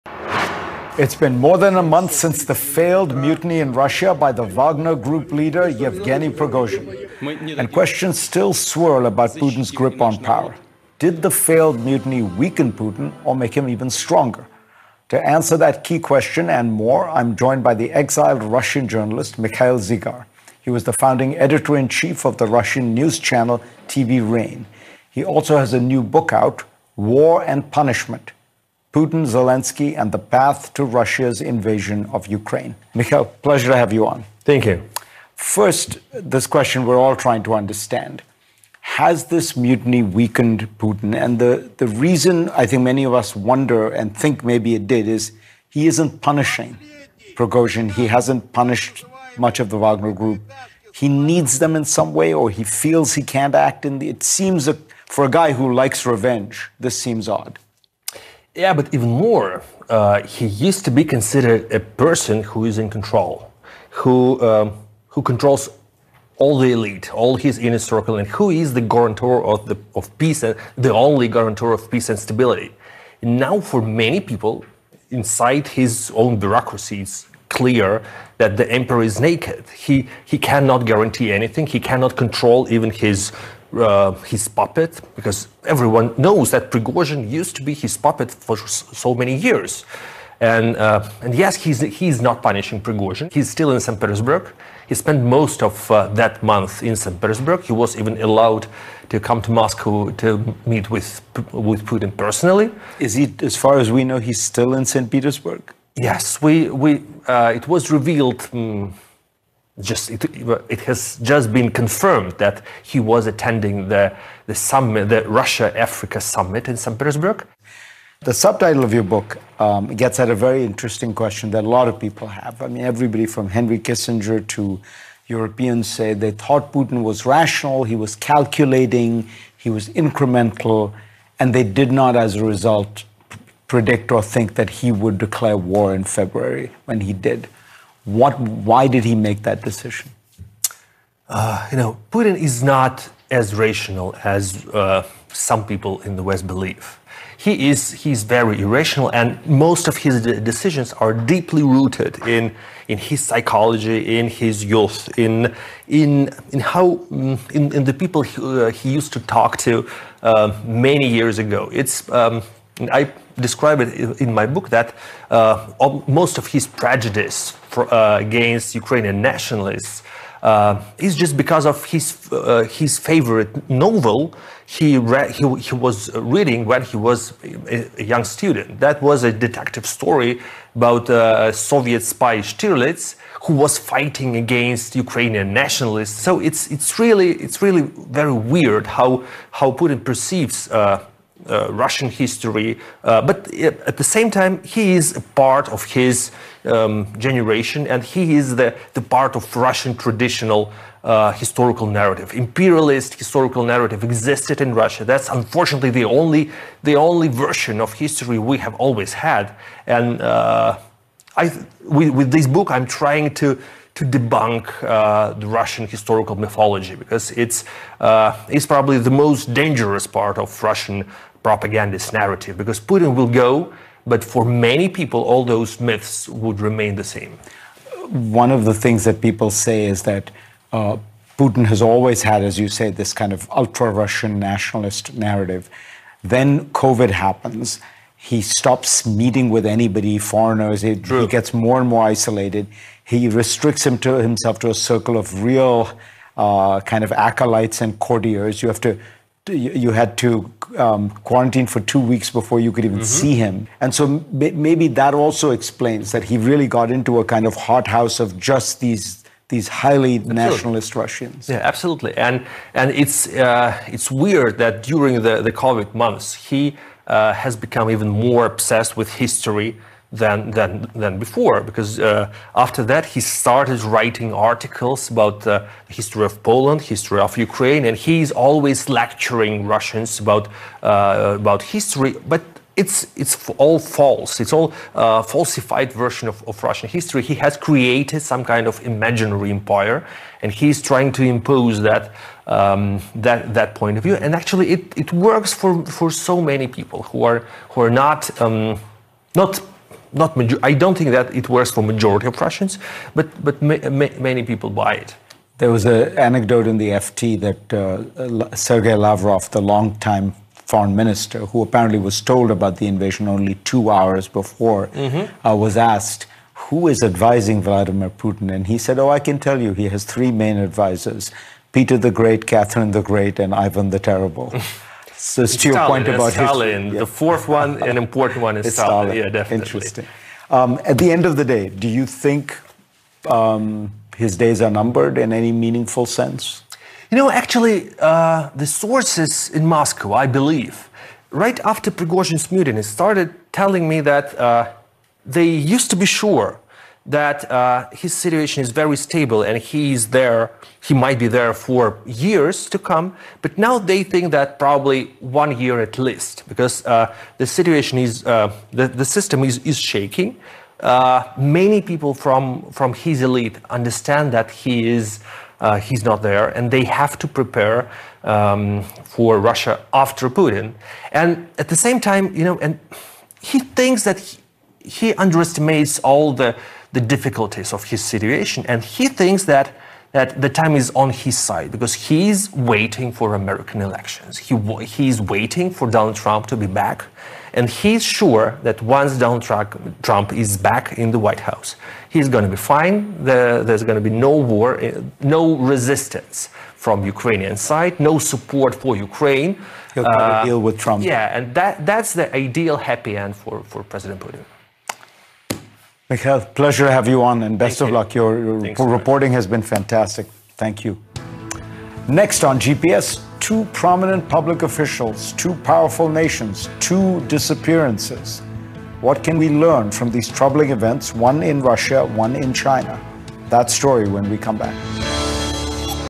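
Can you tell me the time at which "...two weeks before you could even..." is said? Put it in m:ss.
4:11.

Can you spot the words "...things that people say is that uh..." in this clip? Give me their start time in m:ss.
3:48.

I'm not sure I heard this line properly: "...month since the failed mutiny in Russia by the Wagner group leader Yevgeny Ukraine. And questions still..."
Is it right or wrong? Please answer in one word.
wrong.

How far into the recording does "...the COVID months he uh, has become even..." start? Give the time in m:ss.
4:25.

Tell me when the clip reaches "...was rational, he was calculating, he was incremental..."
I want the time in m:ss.
2:07.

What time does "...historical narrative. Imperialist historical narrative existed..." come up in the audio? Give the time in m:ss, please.
3:21.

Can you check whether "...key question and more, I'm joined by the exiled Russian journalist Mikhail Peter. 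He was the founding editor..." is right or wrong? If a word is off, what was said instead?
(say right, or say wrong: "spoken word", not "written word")
wrong: "Zygar", not "Peter".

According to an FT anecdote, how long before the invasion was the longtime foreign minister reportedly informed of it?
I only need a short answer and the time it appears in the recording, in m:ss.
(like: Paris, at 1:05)
two hours, at 5:13.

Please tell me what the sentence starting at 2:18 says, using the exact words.
What, why did he make that decision?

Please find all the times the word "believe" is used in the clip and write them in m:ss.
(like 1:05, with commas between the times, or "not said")
2:26, 5:40.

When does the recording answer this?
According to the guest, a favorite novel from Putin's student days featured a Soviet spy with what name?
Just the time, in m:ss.
3:02.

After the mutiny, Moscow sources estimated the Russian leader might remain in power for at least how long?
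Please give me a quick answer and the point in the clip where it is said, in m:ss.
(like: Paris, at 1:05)
one year, at 5:55.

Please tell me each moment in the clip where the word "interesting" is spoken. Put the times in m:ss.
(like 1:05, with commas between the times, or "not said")
2:00, 5:29.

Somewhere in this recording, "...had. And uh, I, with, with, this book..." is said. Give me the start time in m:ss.
3:29.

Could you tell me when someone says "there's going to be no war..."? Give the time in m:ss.
6:33.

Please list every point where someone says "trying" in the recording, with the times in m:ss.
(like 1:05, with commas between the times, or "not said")
0:37, 3:32, 4:50.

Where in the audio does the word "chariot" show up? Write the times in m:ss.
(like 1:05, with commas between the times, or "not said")
not said.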